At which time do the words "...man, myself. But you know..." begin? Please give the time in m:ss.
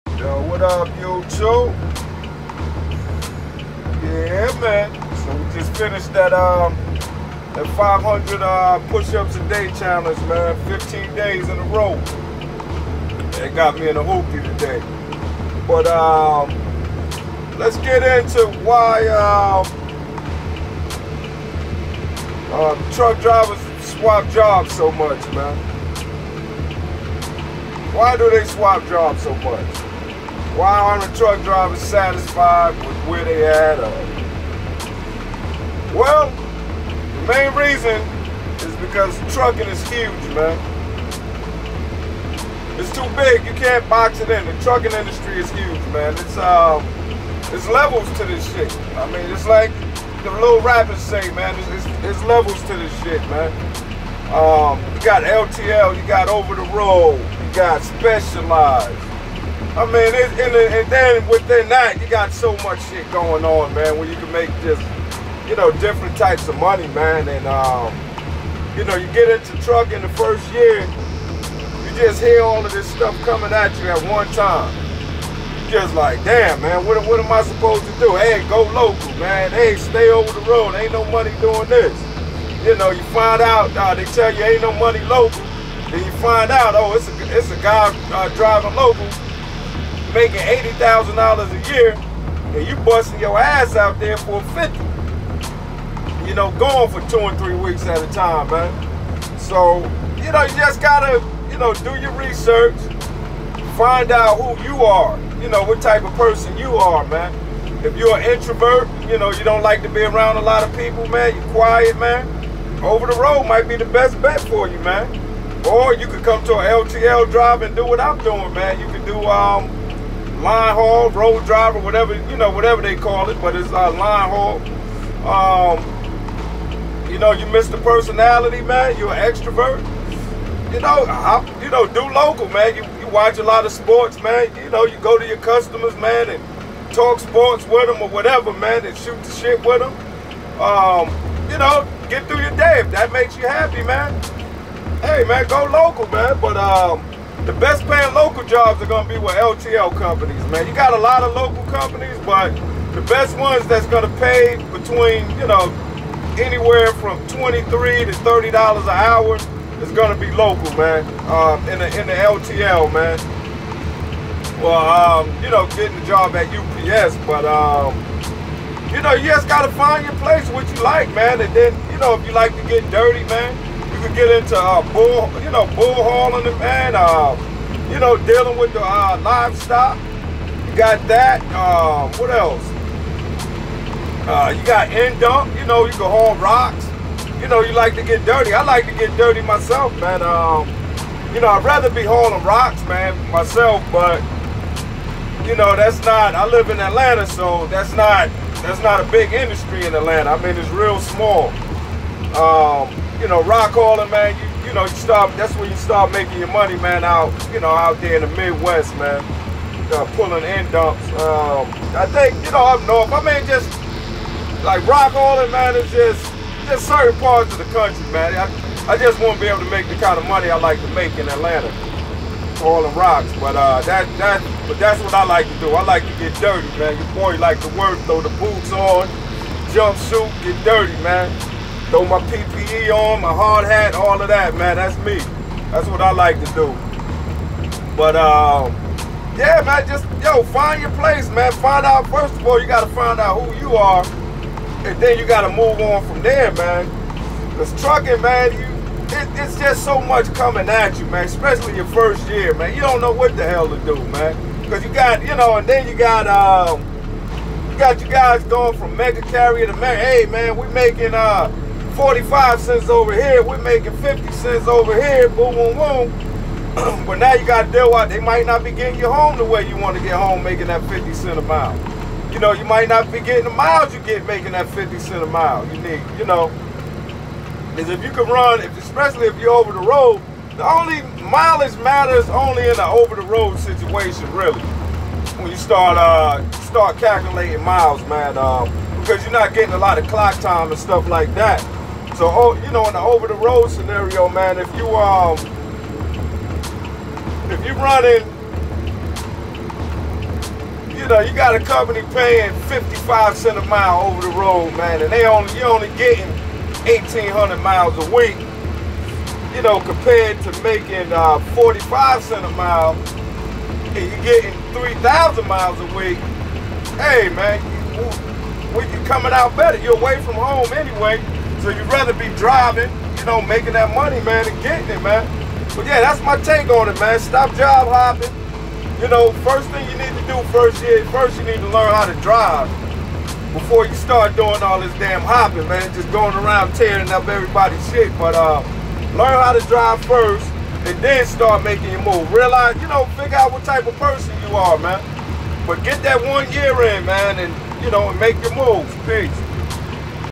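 3:12.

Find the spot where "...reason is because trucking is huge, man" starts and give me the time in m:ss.
0:37.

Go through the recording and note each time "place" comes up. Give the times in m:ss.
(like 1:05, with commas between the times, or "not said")
2:50, 4:00.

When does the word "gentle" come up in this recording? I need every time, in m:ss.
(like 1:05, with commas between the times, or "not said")
not said.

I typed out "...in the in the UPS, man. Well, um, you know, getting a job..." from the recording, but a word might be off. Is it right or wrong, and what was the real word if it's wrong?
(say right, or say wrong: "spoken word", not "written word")
wrong: "LTL", not "UPS".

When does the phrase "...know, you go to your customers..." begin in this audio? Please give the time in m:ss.
2:14.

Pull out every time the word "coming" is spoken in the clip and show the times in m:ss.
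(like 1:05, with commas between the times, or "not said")
1:13, 4:10, 5:19.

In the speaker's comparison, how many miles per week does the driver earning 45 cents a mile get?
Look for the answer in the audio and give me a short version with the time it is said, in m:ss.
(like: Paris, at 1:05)
3,000, at 5:14.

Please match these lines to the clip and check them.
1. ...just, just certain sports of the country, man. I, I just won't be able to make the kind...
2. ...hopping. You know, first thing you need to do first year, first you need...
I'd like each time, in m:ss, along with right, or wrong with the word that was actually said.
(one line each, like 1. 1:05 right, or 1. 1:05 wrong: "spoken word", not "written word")
1. 3:35 wrong: "parts", not "sports"
2. 5:27 right.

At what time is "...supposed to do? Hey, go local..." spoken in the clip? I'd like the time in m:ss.
1:17.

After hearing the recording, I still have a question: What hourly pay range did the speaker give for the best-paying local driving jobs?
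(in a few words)
$23 to $30.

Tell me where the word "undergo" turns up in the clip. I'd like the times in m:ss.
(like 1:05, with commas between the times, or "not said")
not said.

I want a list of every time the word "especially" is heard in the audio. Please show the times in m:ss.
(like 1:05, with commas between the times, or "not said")
4:11, 4:38.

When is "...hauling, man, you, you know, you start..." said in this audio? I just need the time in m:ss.
3:23.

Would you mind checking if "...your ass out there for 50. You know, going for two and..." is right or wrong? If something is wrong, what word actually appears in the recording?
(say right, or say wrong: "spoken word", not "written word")
right.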